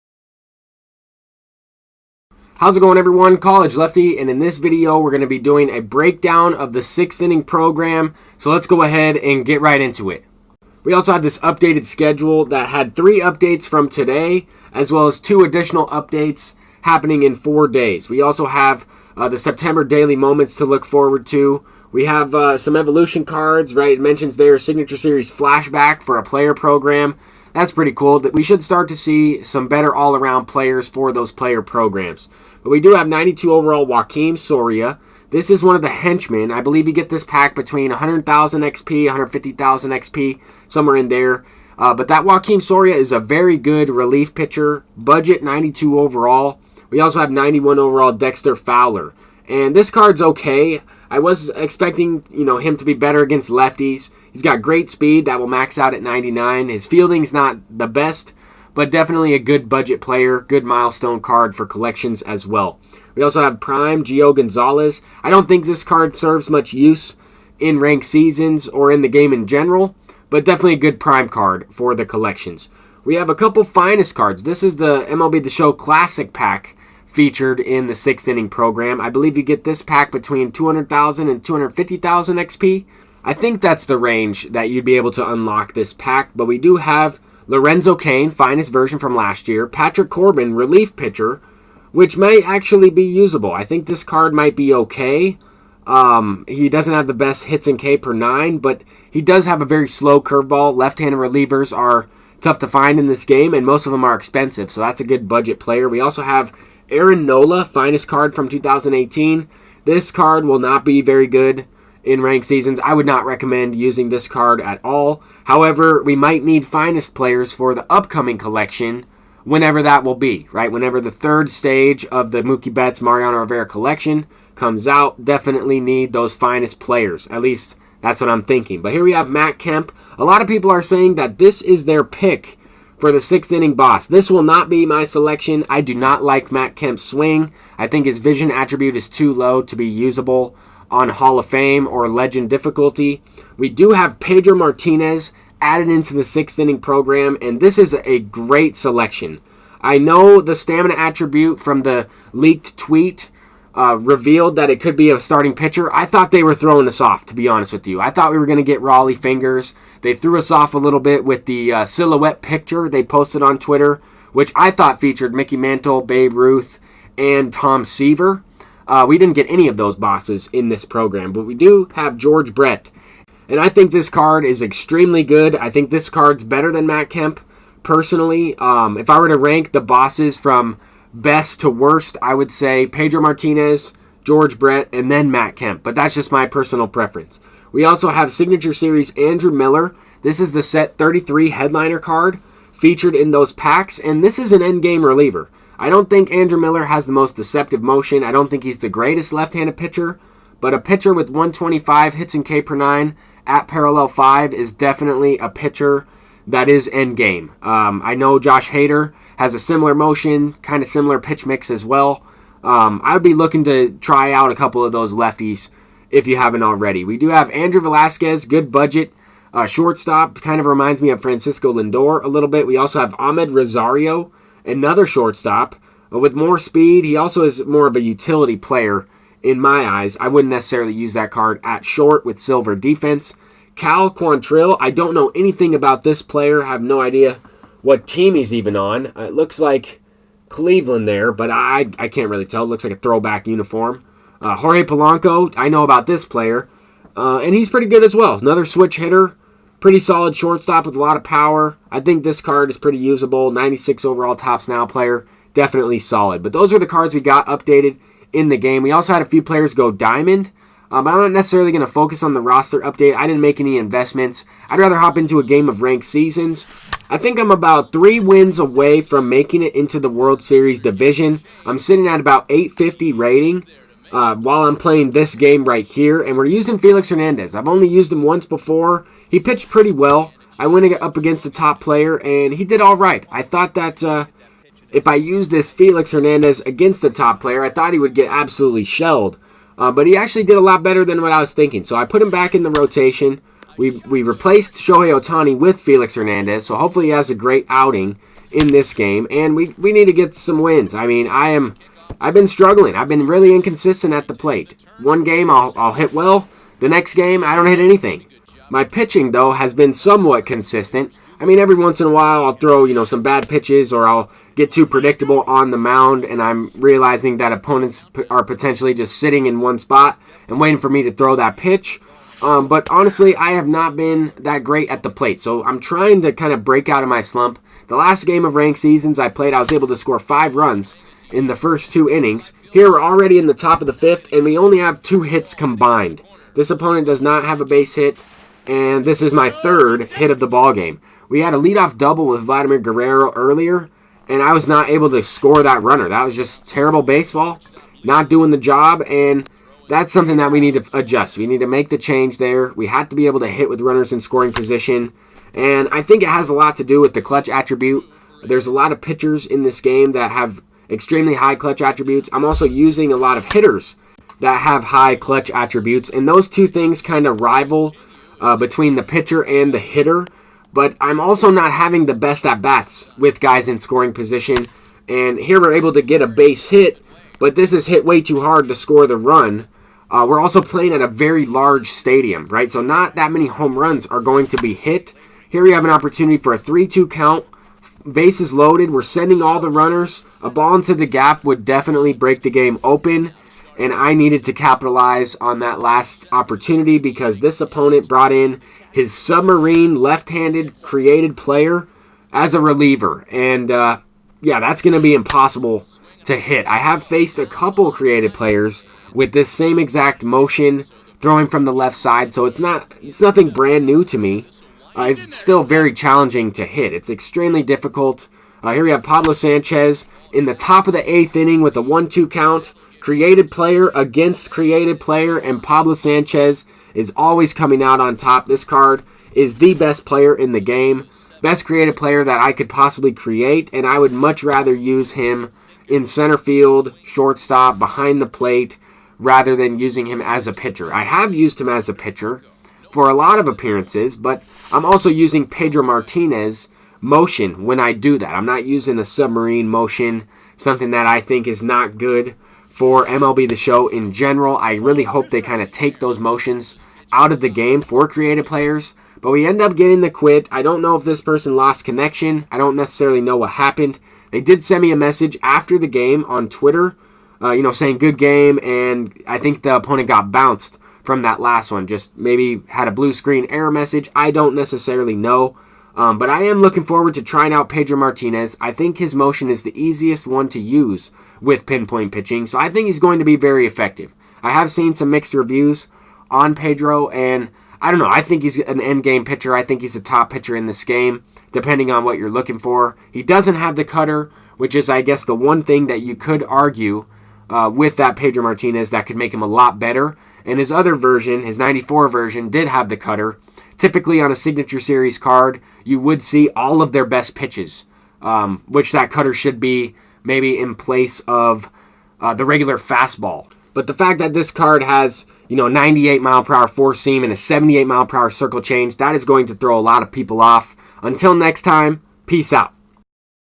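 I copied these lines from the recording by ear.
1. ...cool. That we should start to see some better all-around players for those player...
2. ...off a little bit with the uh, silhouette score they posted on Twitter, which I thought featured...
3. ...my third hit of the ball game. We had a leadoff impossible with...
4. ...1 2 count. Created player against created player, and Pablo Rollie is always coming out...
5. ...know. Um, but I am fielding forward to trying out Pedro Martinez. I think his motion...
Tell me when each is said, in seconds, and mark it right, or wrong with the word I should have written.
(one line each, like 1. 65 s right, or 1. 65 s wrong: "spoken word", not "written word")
1. 27 s right
2. 160 s wrong: "picture", not "score"
3. 339 s wrong: "double", not "impossible"
4. 421 s wrong: "Sanchez", not "Rollie"
5. 475 s wrong: "looking", not "fielding".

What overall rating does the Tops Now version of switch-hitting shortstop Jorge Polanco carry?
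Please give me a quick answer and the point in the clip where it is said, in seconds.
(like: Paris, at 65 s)
96, at 253 s.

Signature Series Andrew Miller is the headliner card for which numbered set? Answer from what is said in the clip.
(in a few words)
33.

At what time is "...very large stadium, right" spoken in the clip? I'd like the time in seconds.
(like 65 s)
381 s.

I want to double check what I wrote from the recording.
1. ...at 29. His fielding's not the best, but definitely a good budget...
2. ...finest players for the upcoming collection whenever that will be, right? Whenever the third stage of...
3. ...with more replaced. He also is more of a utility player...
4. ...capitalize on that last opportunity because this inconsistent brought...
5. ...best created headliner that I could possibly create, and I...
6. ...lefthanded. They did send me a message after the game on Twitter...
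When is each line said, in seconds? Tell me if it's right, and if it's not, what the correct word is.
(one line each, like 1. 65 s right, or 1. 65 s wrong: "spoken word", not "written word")
1. 55 s wrong: "99", not "29"
2. 116 s right
3. 226 s wrong: "speed", not "replaced"
4. 394 s wrong: "opponent", not "inconsistent"
5. 431 s wrong: "player", not "headliner"
6. 463 s wrong: "happened", not "lefthanded".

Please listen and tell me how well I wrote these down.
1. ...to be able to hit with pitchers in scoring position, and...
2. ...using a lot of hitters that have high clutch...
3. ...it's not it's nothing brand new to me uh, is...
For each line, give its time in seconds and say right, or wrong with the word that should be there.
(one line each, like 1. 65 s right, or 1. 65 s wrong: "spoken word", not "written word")
1. 353 s wrong: "runners", not "pitchers"
2. 362 s right
3. 412 s right.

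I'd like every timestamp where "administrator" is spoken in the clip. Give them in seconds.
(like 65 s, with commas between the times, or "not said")
not said.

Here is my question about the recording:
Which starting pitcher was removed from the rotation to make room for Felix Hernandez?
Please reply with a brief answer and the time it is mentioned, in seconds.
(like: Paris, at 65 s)
Shohei Ohtani, at 294 s.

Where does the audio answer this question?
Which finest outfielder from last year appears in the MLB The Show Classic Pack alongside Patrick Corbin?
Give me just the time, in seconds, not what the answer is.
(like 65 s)
87 s.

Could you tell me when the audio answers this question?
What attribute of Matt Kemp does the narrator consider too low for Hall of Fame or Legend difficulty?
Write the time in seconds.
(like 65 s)
138 s.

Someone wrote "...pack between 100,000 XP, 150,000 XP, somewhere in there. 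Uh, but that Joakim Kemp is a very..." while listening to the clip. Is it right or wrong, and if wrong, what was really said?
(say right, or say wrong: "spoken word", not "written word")
wrong: "Soria", not "Kemp".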